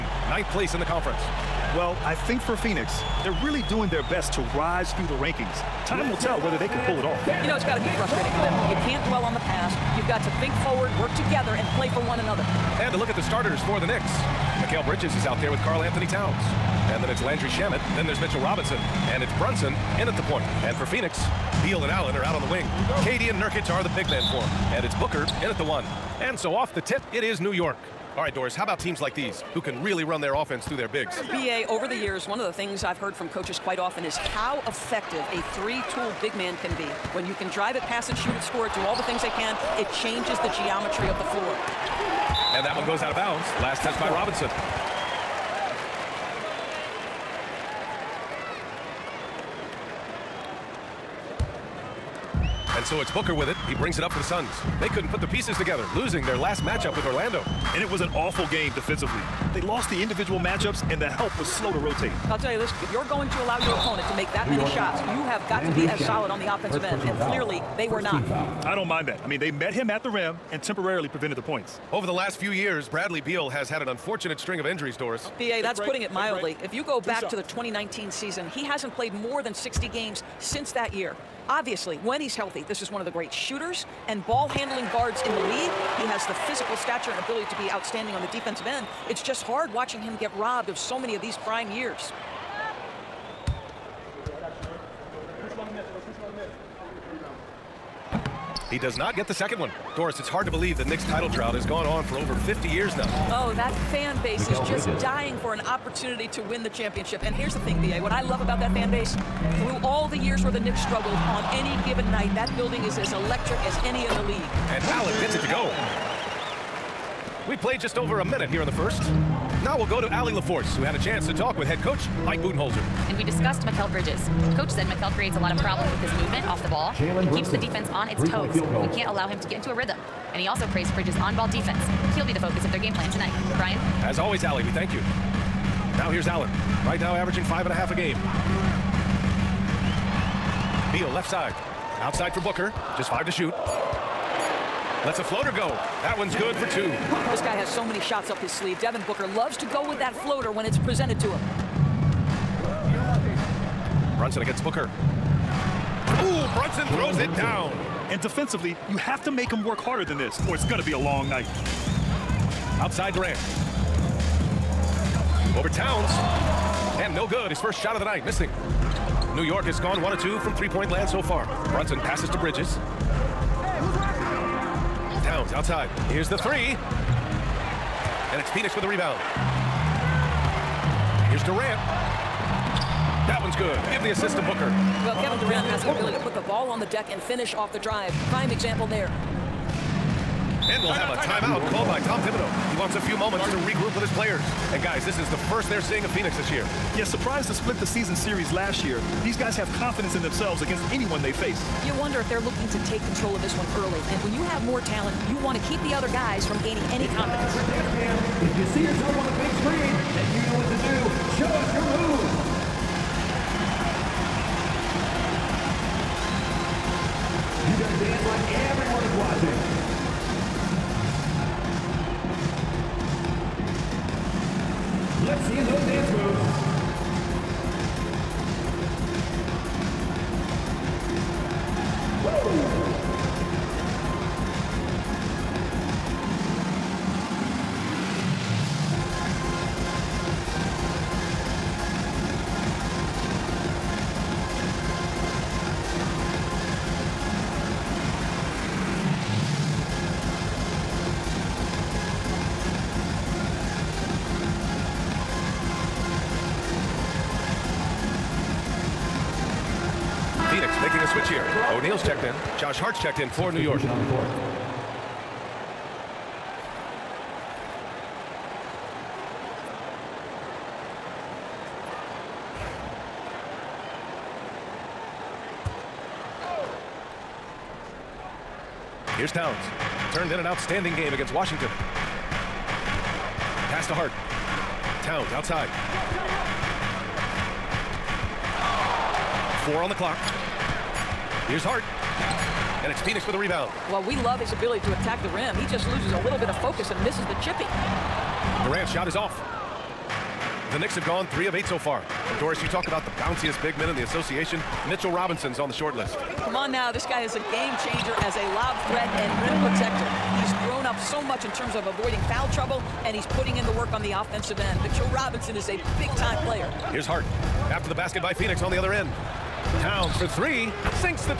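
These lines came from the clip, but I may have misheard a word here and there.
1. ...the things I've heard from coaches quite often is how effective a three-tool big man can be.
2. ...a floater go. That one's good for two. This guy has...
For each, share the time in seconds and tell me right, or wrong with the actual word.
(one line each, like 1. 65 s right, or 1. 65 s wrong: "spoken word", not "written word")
1. 32 s right
2. 145 s right.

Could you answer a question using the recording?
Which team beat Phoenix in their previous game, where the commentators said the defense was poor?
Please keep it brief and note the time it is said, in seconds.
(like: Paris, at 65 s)
Orlando, at 57 s.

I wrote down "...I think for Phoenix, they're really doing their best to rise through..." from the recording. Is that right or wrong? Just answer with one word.
right.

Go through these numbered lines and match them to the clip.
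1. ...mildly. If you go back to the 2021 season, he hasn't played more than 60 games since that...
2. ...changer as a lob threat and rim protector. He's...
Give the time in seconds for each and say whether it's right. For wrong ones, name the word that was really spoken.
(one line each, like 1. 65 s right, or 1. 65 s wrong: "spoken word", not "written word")
1. 76 s wrong: "2019", not "2021"
2. 307 s right.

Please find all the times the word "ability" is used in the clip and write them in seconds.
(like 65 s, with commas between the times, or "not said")
87 s, 185 s, 294 s.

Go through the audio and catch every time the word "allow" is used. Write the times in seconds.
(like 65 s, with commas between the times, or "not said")
63 s, 129 s.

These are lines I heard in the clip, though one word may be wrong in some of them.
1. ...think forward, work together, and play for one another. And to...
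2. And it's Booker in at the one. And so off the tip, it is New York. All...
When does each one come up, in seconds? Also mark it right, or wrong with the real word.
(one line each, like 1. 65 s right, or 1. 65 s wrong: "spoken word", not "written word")
1. 10 s right
2. 24 s right.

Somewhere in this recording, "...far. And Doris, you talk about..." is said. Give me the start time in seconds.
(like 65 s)
301 s.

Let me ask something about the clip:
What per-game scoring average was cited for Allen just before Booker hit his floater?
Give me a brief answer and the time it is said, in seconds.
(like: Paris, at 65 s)
5.5, at 137 s.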